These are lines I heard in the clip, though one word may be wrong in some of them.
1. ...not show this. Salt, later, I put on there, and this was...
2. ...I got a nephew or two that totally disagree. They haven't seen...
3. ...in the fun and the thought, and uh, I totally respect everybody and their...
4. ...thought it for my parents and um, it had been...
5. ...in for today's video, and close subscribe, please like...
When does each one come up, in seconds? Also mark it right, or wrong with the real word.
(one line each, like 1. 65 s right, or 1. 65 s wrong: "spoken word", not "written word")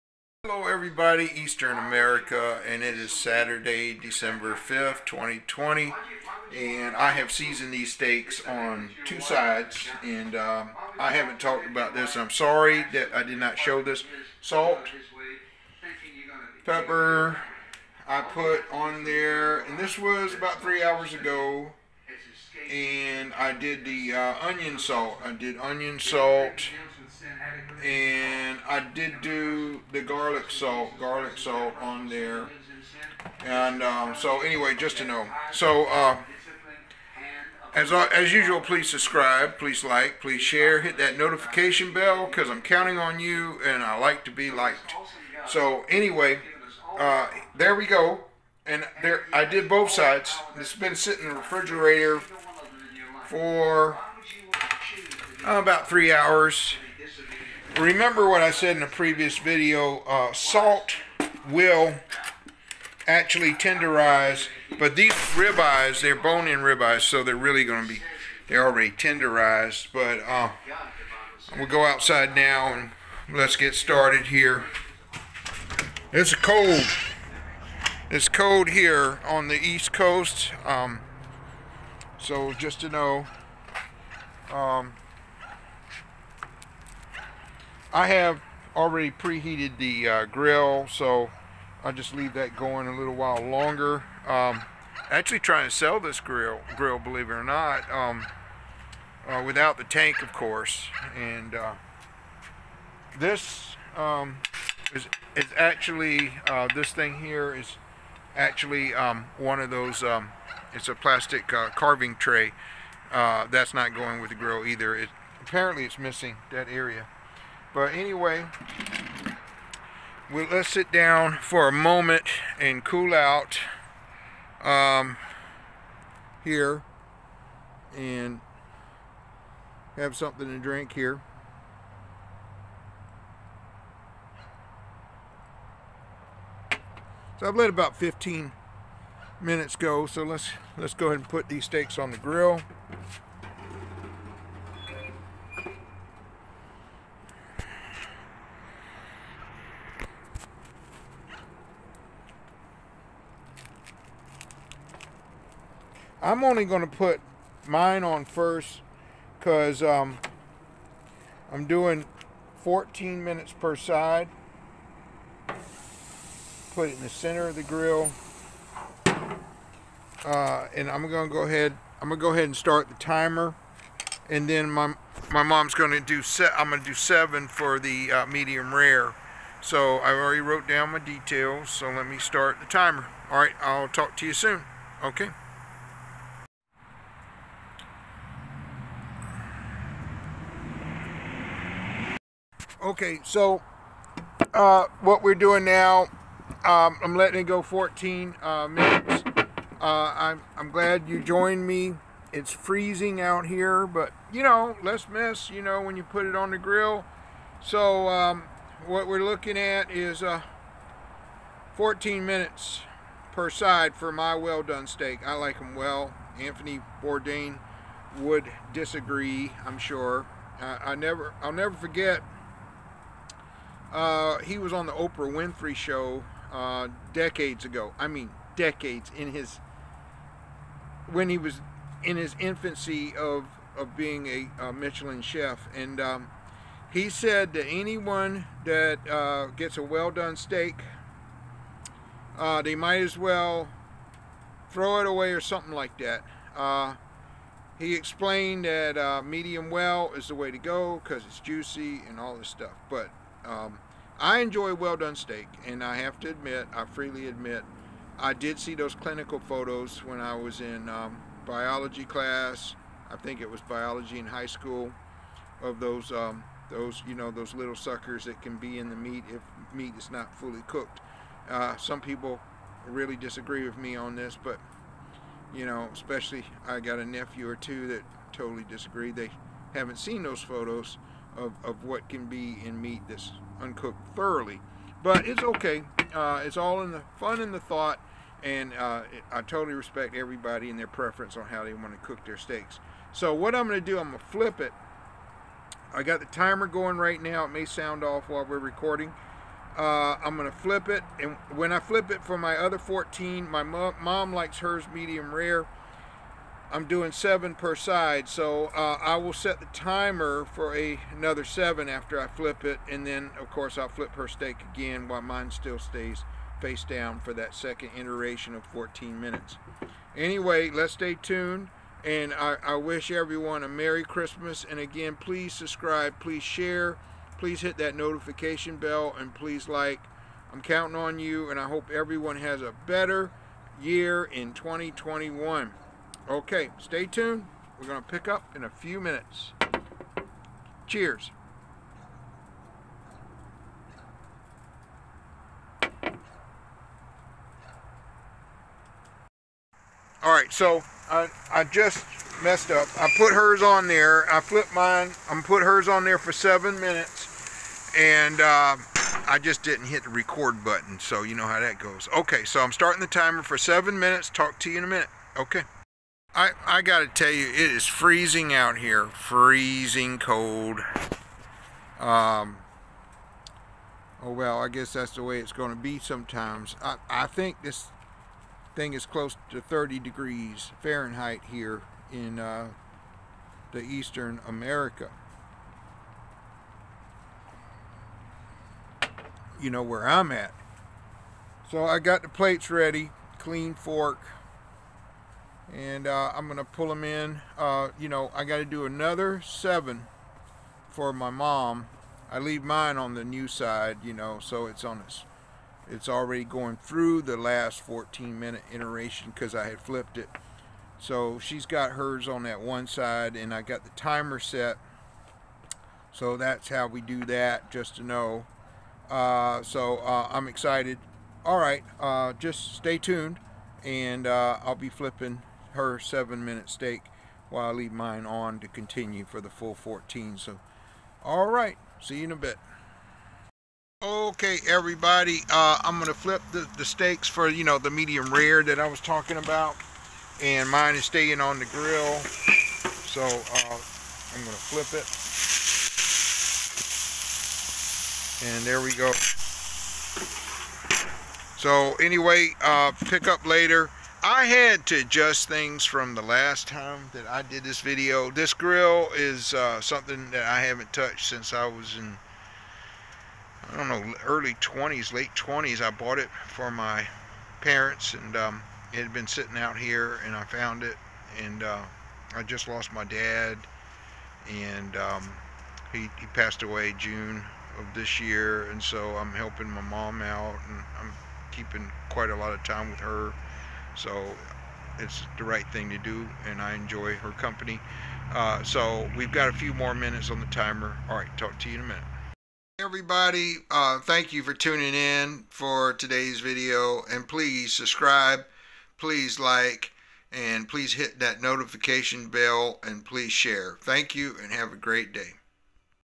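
1. 13 s wrong: "pepper", not "later"
2. 276 s right
3. 286 s right
4. 465 s wrong: "bought", not "thought"
5. 494 s wrong: "please", not "close".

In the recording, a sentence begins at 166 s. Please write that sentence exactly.
Put it in the center of the grill.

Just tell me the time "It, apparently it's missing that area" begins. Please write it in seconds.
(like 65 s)
114 s.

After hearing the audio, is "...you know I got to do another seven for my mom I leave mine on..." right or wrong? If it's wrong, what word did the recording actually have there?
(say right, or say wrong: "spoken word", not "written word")
right.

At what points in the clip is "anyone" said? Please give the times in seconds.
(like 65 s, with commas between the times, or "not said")
237 s.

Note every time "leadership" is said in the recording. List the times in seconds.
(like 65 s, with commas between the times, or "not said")
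not said.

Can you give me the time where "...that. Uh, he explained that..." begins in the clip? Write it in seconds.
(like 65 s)
245 s.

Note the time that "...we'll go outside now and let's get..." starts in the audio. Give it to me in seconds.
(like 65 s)
71 s.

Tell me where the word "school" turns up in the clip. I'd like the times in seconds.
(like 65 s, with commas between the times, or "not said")
264 s.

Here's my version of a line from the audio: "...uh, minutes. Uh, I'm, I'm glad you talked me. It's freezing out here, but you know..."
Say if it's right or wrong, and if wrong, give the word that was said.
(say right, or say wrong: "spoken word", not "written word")
wrong: "joined", not "talked".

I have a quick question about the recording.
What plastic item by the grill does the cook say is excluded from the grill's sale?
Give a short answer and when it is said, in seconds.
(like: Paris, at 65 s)
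carving tray, at 111 s.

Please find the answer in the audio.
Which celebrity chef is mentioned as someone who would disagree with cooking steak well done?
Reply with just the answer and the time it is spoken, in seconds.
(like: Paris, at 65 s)
Anthony Bourdain, at 216 s.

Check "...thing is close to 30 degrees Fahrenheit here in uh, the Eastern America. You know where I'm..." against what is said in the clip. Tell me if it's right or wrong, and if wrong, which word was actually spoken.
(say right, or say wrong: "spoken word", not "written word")
right.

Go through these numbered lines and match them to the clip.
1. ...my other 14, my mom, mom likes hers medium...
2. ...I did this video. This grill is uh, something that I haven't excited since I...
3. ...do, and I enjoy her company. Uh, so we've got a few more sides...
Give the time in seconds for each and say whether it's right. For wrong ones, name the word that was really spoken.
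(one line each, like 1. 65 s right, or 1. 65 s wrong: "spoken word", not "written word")
1. 302 s right
2. 457 s wrong: "touched", not "excited"
3. 485 s wrong: "minutes", not "sides".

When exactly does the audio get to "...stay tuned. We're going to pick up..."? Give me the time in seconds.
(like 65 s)
336 s.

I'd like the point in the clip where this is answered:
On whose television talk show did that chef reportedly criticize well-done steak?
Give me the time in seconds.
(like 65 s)
224 s.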